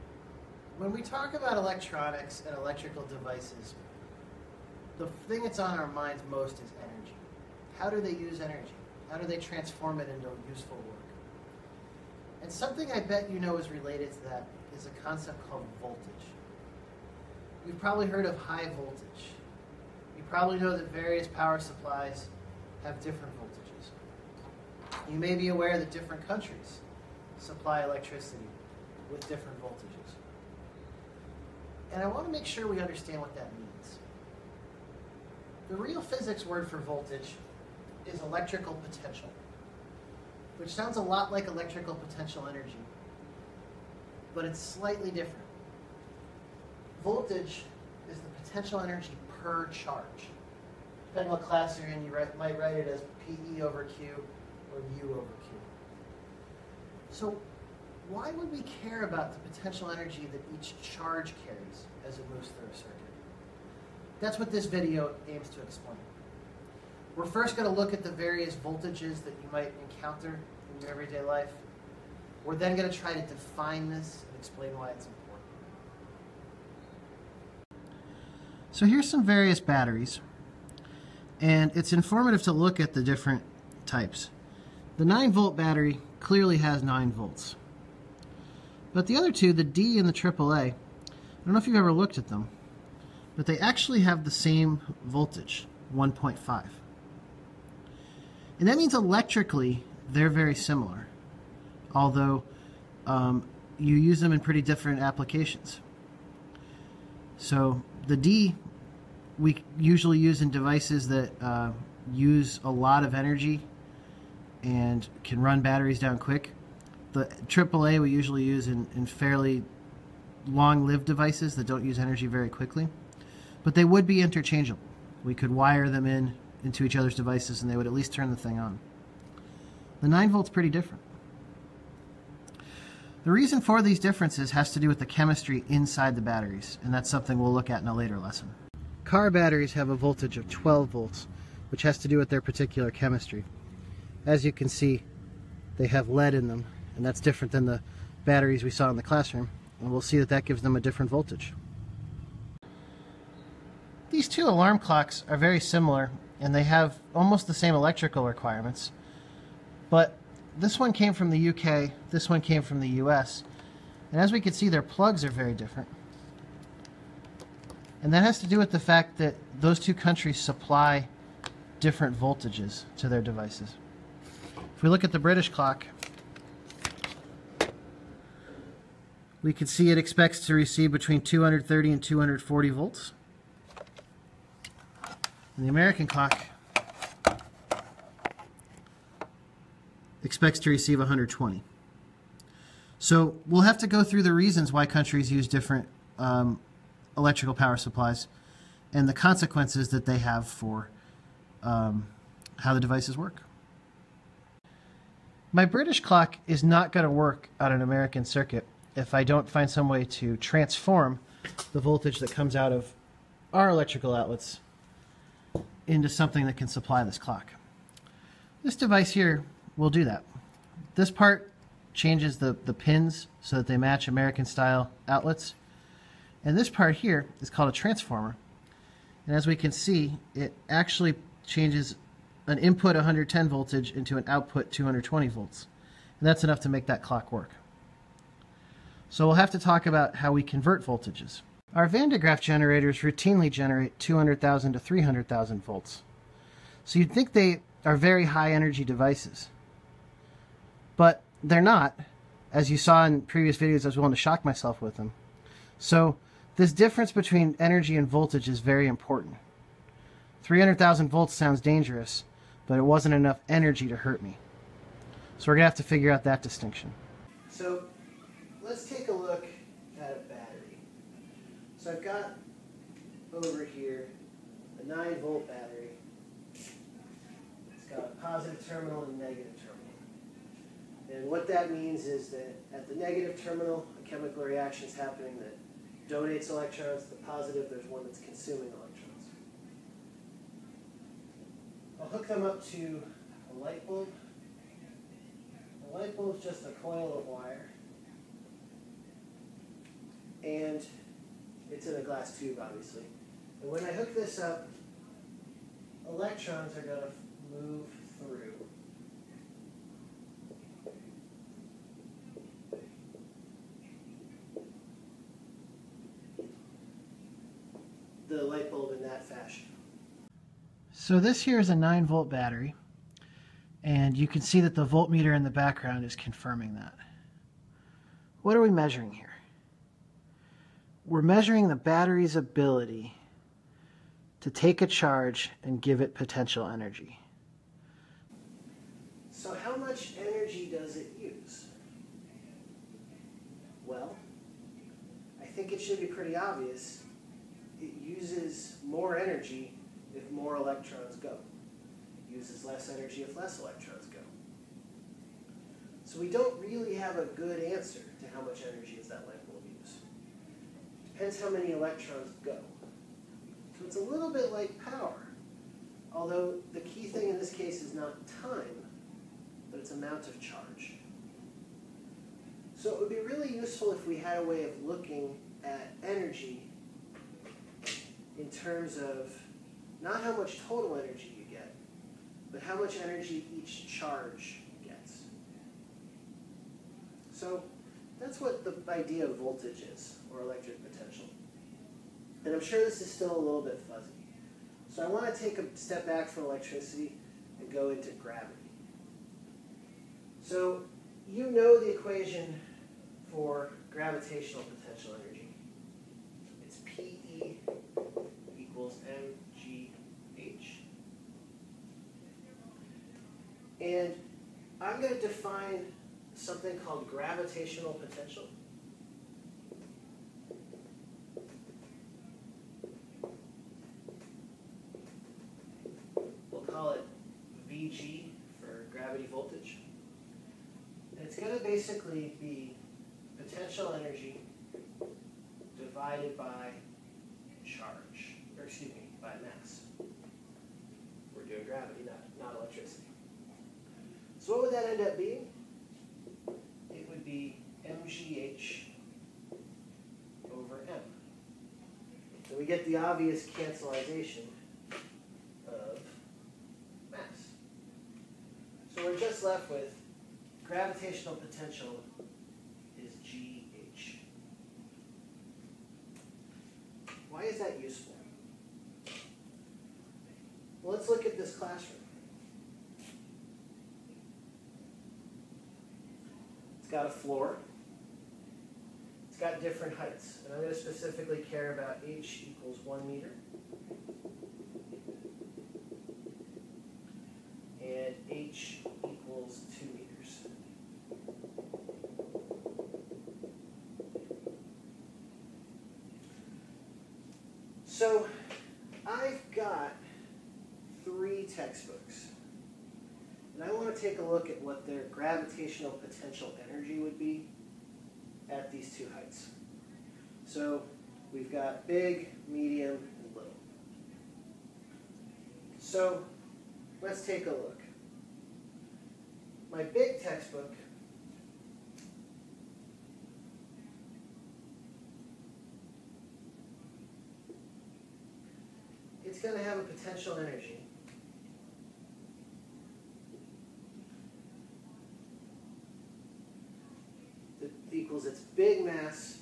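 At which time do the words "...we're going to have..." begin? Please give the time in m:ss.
4:25.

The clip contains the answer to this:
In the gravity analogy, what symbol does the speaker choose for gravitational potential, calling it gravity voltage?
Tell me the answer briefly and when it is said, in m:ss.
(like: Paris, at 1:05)
VG, at 7:07.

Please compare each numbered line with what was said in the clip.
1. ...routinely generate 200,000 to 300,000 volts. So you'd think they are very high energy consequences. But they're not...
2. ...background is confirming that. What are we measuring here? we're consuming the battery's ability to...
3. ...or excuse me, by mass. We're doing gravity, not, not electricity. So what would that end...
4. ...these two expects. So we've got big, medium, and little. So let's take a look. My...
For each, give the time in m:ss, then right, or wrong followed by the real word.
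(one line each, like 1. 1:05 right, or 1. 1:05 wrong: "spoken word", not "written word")
1. 4:02 wrong: "devices", not "consequences"
2. 5:25 wrong: "measuring", not "consuming"
3. 7:18 right
4. 8:28 wrong: "heights", not "expects".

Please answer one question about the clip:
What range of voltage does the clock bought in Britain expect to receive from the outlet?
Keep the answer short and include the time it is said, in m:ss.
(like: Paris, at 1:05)
230 to 240 volts, at 3:00.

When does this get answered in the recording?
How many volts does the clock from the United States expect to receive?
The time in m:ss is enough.
3:10.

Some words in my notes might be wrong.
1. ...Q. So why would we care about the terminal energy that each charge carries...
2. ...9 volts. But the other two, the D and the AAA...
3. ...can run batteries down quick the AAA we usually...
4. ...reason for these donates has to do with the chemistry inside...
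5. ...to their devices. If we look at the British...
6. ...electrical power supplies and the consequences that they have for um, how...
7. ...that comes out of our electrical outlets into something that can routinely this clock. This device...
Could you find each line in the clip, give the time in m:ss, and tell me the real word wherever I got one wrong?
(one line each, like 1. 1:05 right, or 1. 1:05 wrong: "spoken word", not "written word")
1. 0:55 wrong: "potential", not "terminal"
2. 1:26 right
3. 1:55 right
4. 2:13 wrong: "differences", not "donates"
5. 2:52 right
6. 3:17 right
7. 3:32 wrong: "supply", not "routinely".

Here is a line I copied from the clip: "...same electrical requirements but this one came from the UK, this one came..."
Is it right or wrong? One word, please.
right.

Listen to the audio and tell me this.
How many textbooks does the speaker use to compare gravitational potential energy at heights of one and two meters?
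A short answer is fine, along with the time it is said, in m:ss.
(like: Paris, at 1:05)
3, at 8:21.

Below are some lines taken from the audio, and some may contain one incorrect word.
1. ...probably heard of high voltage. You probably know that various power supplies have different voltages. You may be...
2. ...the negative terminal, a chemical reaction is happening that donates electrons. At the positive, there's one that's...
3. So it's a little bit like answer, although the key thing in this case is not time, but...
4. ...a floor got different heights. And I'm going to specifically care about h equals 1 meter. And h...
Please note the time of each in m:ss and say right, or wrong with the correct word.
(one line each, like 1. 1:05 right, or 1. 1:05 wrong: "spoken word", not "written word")
1. 0:17 right
2. 4:42 right
3. 6:03 wrong: "power", not "answer"
4. 7:57 right.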